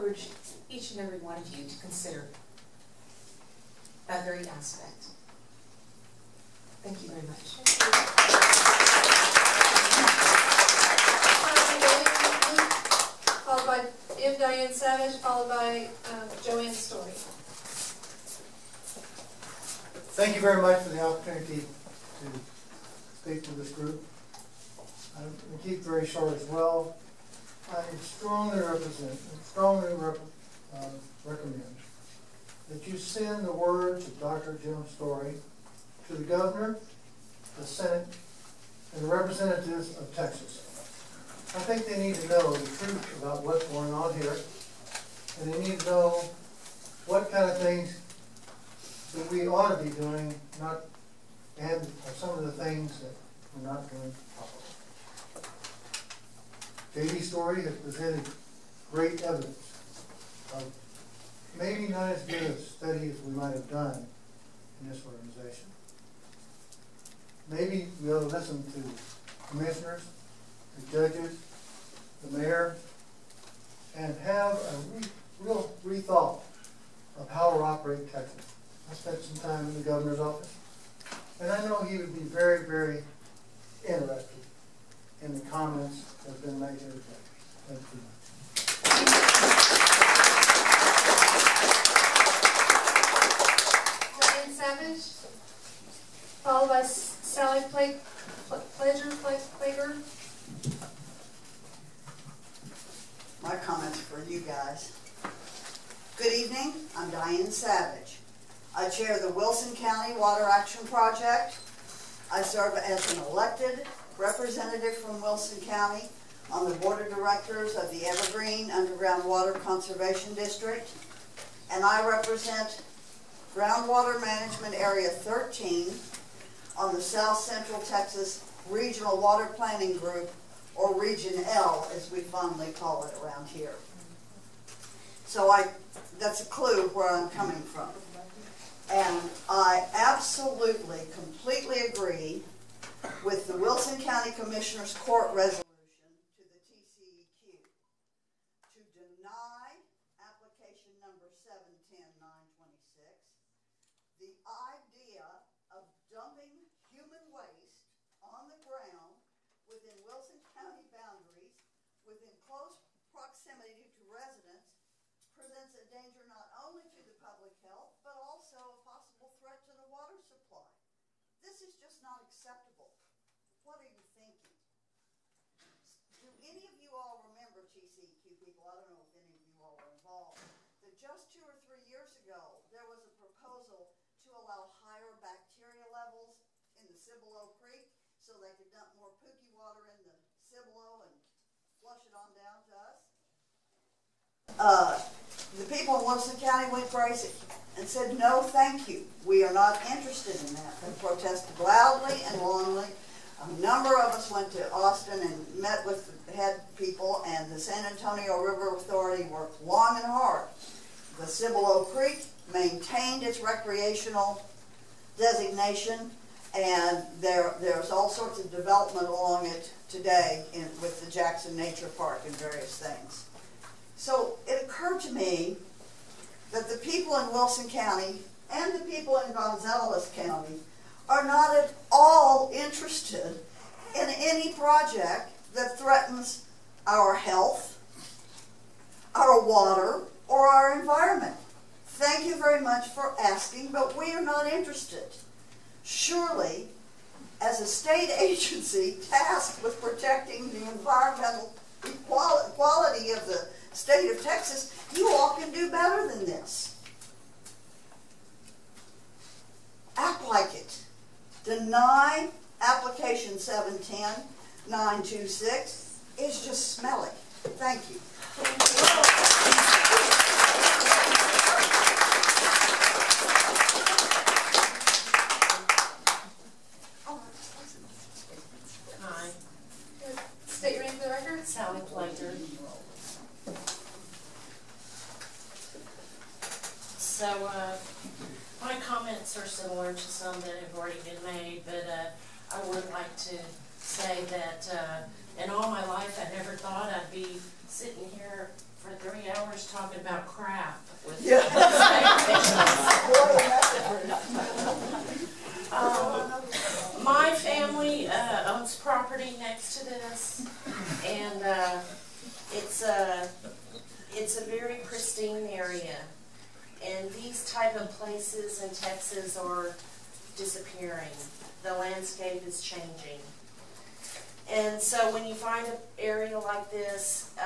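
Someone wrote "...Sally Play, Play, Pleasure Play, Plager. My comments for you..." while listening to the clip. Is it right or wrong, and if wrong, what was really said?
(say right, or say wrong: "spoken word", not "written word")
right.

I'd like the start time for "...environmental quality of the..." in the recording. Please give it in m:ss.
4:10.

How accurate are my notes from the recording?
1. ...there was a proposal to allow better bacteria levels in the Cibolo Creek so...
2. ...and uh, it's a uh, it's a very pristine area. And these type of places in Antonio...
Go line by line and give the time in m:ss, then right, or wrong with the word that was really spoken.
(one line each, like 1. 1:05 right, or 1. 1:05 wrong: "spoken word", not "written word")
1. 3:02 wrong: "higher", not "better"
2. 5:11 wrong: "Texas", not "Antonio".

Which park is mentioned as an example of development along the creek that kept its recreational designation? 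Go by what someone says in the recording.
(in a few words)
Jackson Nature Park.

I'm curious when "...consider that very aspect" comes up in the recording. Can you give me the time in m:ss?
0:01.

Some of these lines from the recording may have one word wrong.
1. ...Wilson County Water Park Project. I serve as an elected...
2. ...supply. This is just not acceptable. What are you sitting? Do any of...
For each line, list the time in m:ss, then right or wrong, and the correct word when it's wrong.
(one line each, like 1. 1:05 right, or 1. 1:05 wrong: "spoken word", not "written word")
1. 1:49 wrong: "Action", not "Park"
2. 2:50 wrong: "thinking", not "sitting".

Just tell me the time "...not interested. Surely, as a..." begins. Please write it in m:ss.
4:04.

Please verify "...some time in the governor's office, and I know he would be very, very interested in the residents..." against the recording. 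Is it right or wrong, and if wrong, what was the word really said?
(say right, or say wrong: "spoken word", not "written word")
wrong: "comments", not "residents".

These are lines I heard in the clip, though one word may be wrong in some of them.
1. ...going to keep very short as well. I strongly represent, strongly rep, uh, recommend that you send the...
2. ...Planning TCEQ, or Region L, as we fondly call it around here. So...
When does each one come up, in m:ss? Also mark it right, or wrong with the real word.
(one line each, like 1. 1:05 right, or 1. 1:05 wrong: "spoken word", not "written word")
1. 0:25 right
2. 2:09 wrong: "Group", not "TCEQ".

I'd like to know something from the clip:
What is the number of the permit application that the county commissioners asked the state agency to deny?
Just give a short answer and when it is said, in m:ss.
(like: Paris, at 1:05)
710926, at 2:31.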